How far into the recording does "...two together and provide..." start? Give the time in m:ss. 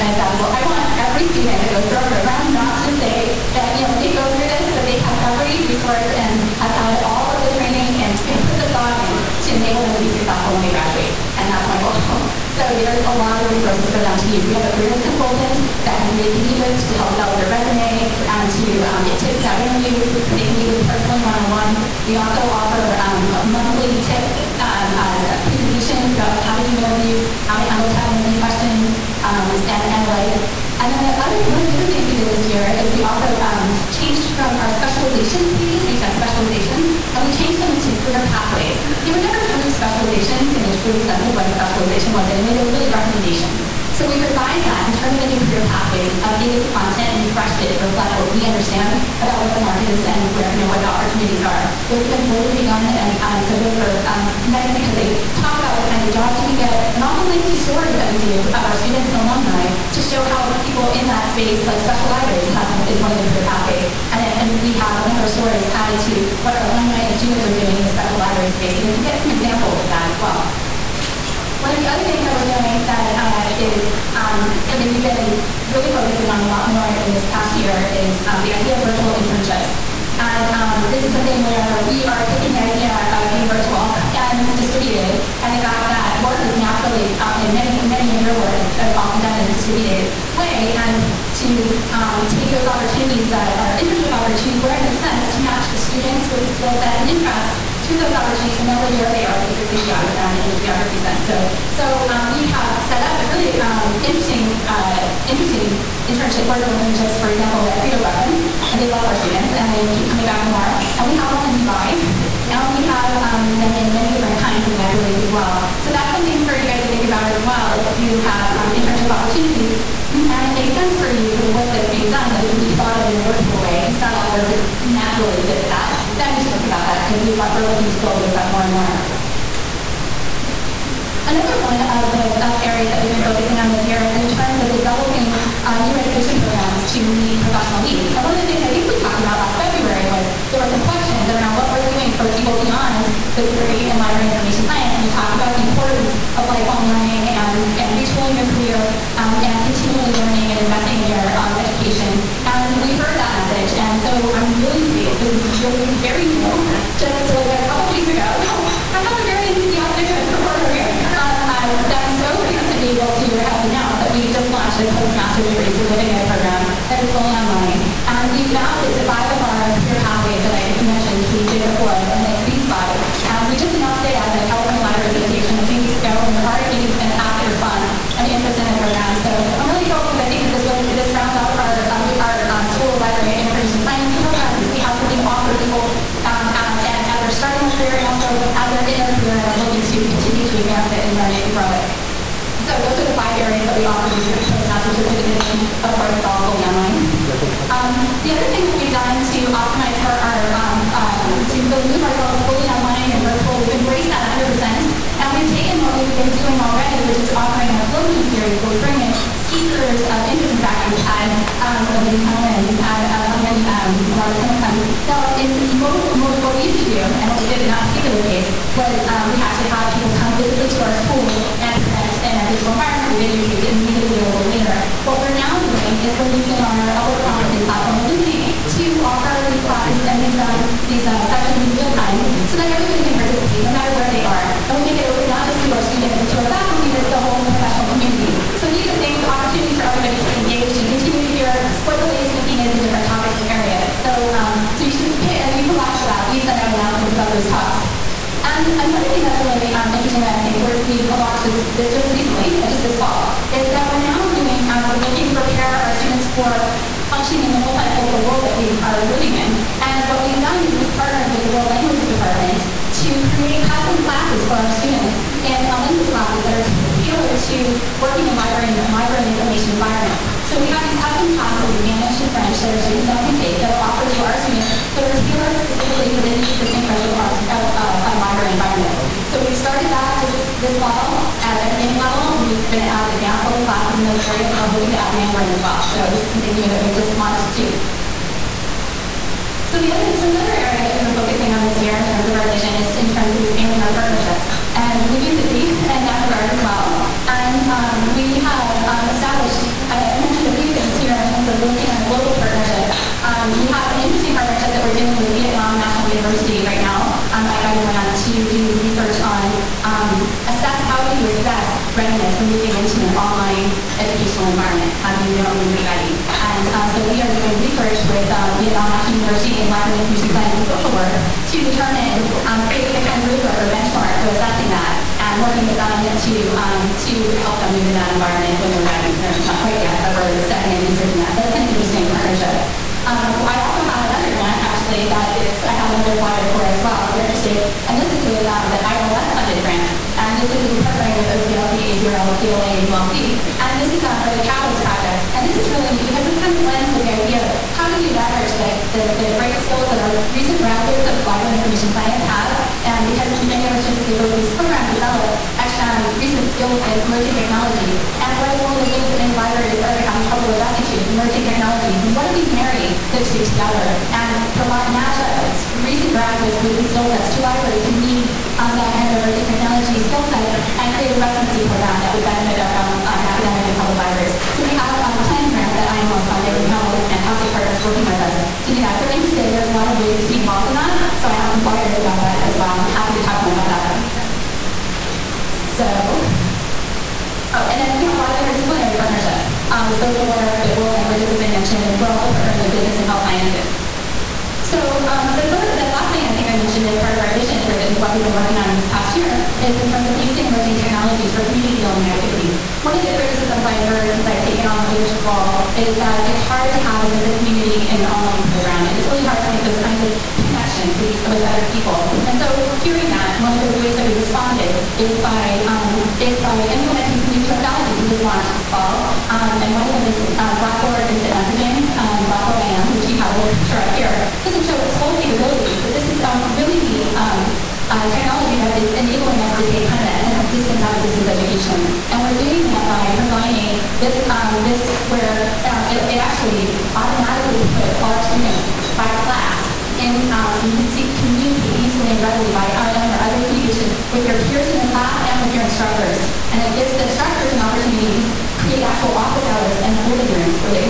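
6:03.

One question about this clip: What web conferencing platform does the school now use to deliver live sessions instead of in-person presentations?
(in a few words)
Elluminate.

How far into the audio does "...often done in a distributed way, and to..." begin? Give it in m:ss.
1:28.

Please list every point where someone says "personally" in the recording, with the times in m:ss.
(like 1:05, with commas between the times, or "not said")
0:20.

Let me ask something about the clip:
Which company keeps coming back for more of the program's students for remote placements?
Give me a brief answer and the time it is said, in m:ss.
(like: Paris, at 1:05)
Credo Reference, at 1:47.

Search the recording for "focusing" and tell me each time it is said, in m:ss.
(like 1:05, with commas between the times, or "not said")
1:15, 2:13, 4:51.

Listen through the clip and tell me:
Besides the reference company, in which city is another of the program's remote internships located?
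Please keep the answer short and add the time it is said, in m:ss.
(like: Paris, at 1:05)
Dubai, at 1:51.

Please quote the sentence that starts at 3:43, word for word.
We videotaped it and made it available later.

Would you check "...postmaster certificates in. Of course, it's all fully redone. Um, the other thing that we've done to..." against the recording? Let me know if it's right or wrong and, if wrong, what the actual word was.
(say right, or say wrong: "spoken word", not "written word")
wrong: "online", not "redone".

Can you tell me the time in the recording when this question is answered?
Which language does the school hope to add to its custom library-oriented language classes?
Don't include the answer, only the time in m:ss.
4:45.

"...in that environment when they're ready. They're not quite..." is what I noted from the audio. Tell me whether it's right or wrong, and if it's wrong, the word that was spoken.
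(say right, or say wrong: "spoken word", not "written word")
right.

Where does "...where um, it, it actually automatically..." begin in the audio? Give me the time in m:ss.
7:15.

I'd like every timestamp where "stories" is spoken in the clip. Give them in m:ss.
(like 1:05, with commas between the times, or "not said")
0:57, 1:05.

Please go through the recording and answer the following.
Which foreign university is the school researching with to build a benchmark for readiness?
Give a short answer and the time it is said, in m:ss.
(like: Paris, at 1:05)
Vietnam National University, at 5:18.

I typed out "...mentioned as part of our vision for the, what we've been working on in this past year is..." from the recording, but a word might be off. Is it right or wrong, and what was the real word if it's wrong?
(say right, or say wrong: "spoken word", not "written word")
right.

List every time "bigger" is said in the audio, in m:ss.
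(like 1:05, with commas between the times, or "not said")
not said.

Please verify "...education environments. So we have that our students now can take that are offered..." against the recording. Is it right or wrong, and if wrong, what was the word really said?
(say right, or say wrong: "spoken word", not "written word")
wrong: "information", not "education".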